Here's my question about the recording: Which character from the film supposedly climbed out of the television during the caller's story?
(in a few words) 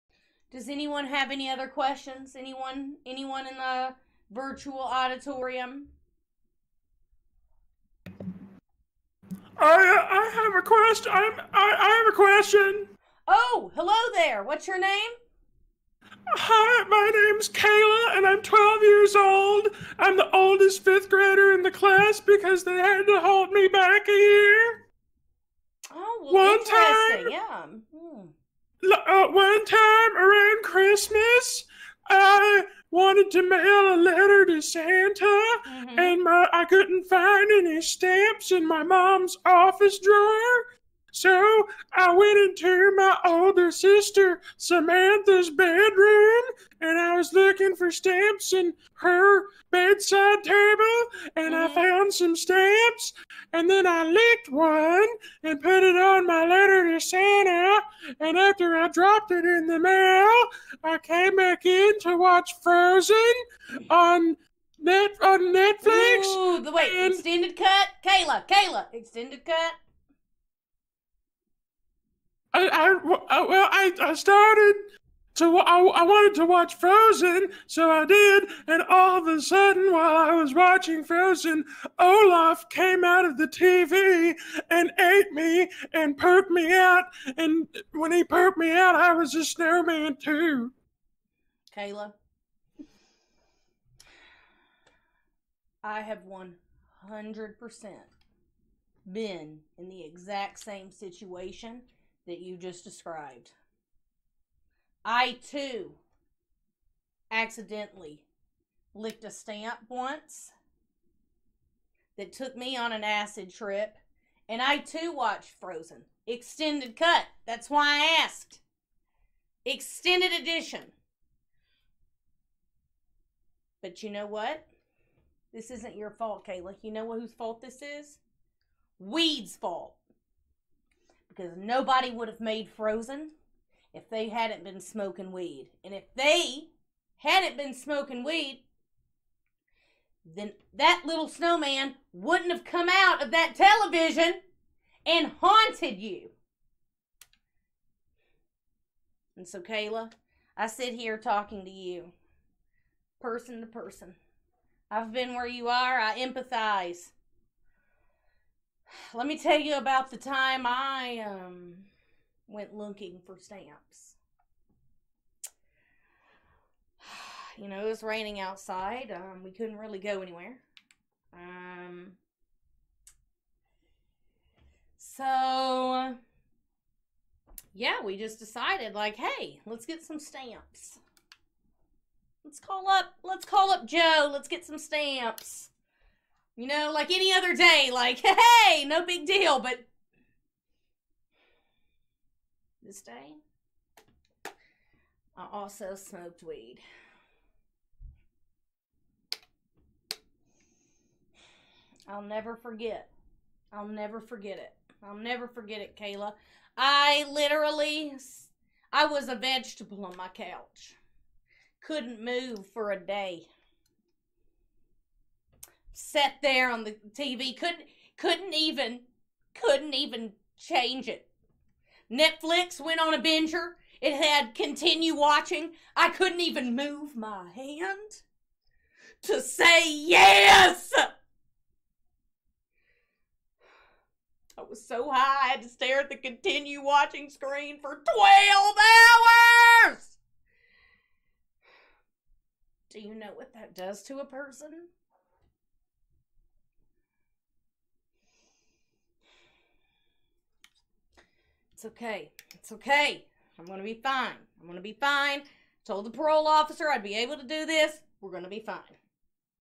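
Olaf.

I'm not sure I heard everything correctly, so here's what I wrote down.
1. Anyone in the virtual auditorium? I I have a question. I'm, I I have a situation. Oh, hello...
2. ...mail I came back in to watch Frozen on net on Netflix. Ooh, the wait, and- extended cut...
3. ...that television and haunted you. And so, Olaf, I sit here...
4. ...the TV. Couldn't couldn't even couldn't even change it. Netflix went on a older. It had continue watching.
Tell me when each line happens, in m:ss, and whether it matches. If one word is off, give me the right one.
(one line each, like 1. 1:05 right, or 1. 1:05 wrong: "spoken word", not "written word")
1. 0:03 wrong: "question", not "situation"
2. 0:59 right
3. 2:23 wrong: "Kayla", not "Olaf"
4. 3:36 wrong: "binger", not "older".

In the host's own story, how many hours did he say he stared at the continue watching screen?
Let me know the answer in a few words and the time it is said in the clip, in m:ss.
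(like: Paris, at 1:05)
12, at 3:58.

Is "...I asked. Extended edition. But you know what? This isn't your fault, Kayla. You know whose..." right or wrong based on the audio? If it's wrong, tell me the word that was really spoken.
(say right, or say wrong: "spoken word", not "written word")
right.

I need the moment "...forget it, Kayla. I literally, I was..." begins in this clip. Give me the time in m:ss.
3:25.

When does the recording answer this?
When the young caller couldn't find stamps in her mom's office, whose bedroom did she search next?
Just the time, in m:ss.
0:44.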